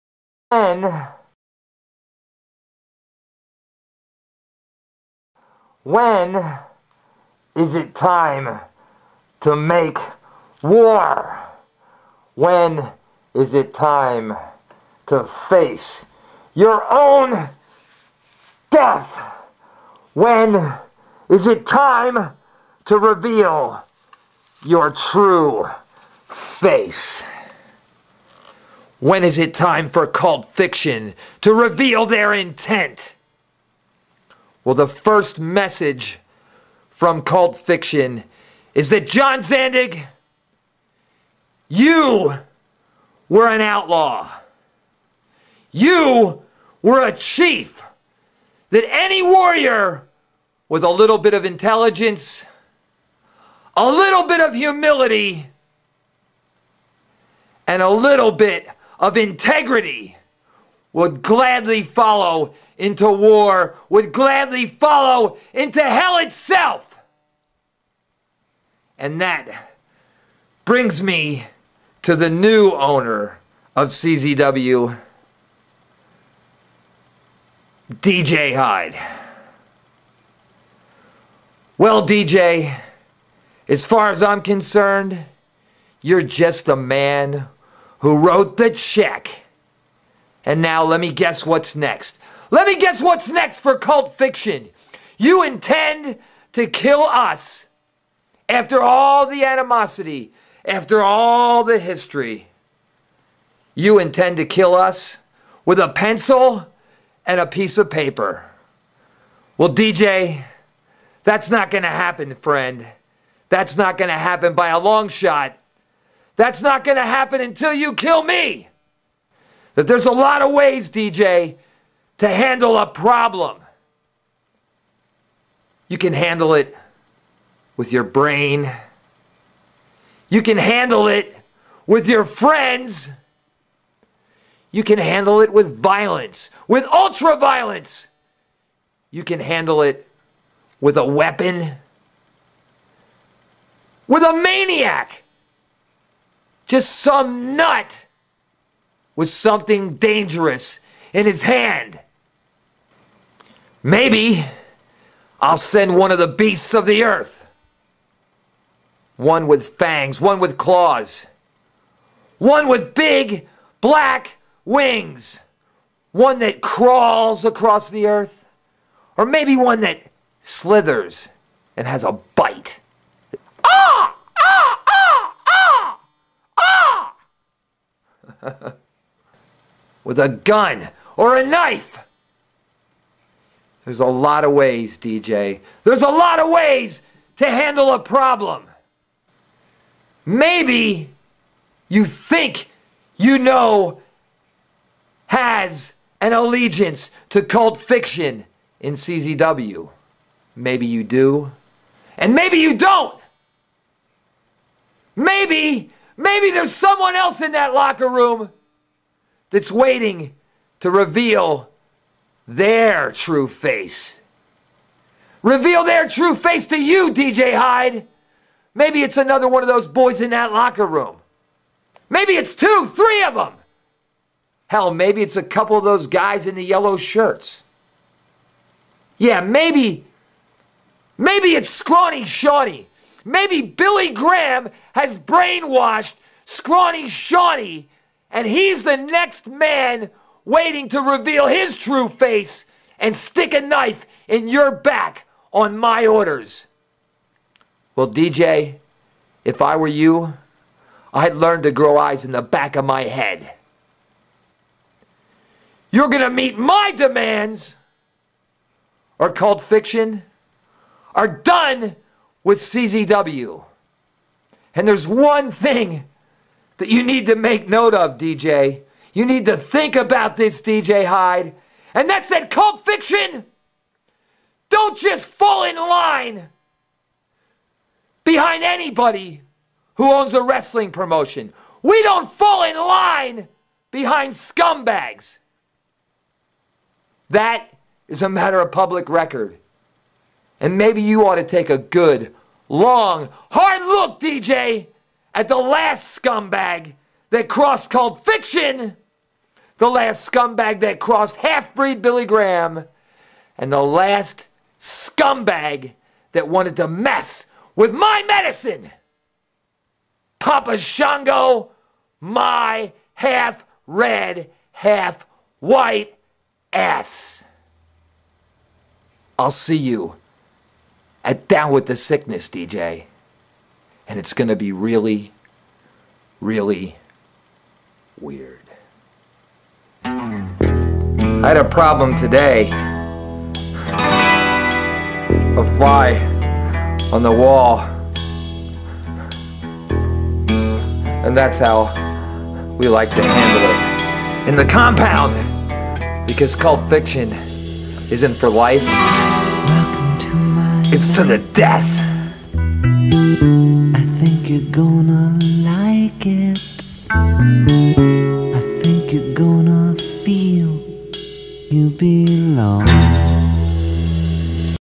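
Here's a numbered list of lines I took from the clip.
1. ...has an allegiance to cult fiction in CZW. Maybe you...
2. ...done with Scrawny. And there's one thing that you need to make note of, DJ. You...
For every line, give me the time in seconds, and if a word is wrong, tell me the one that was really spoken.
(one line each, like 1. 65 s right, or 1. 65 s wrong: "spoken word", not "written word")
1. 195 s right
2. 261 s wrong: "CZW", not "Scrawny".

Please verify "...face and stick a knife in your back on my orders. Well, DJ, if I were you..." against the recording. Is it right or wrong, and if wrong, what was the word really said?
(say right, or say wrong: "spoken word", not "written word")
right.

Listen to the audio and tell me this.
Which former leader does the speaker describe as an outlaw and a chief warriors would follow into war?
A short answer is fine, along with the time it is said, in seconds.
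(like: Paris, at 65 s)
John Zandig, at 39 s.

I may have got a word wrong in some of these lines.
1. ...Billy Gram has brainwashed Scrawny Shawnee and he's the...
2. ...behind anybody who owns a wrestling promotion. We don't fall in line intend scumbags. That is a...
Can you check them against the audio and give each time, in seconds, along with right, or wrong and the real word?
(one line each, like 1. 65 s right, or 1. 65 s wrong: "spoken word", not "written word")
1. 233 s right
2. 278 s wrong: "behind", not "intend".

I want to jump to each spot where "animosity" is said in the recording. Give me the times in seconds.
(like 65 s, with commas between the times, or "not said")
99 s.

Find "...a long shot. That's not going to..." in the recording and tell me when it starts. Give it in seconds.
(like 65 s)
114 s.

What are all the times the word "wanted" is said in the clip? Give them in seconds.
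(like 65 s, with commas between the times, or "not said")
306 s.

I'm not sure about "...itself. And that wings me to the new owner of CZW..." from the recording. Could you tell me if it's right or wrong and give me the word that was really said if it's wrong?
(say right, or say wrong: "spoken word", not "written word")
wrong: "brings", not "wings".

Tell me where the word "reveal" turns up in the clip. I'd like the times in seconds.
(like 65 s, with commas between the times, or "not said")
22 s, 31 s, 210 s, 215 s, 241 s.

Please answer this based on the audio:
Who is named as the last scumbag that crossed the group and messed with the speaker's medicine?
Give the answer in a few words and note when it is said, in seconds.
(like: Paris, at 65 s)
Papa Shango, at 310 s.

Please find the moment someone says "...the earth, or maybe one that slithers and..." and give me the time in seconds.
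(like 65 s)
167 s.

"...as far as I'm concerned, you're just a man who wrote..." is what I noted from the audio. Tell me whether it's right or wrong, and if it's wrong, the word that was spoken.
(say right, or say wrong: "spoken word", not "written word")
right.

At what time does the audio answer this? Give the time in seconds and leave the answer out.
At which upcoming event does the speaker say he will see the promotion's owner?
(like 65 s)
321 s.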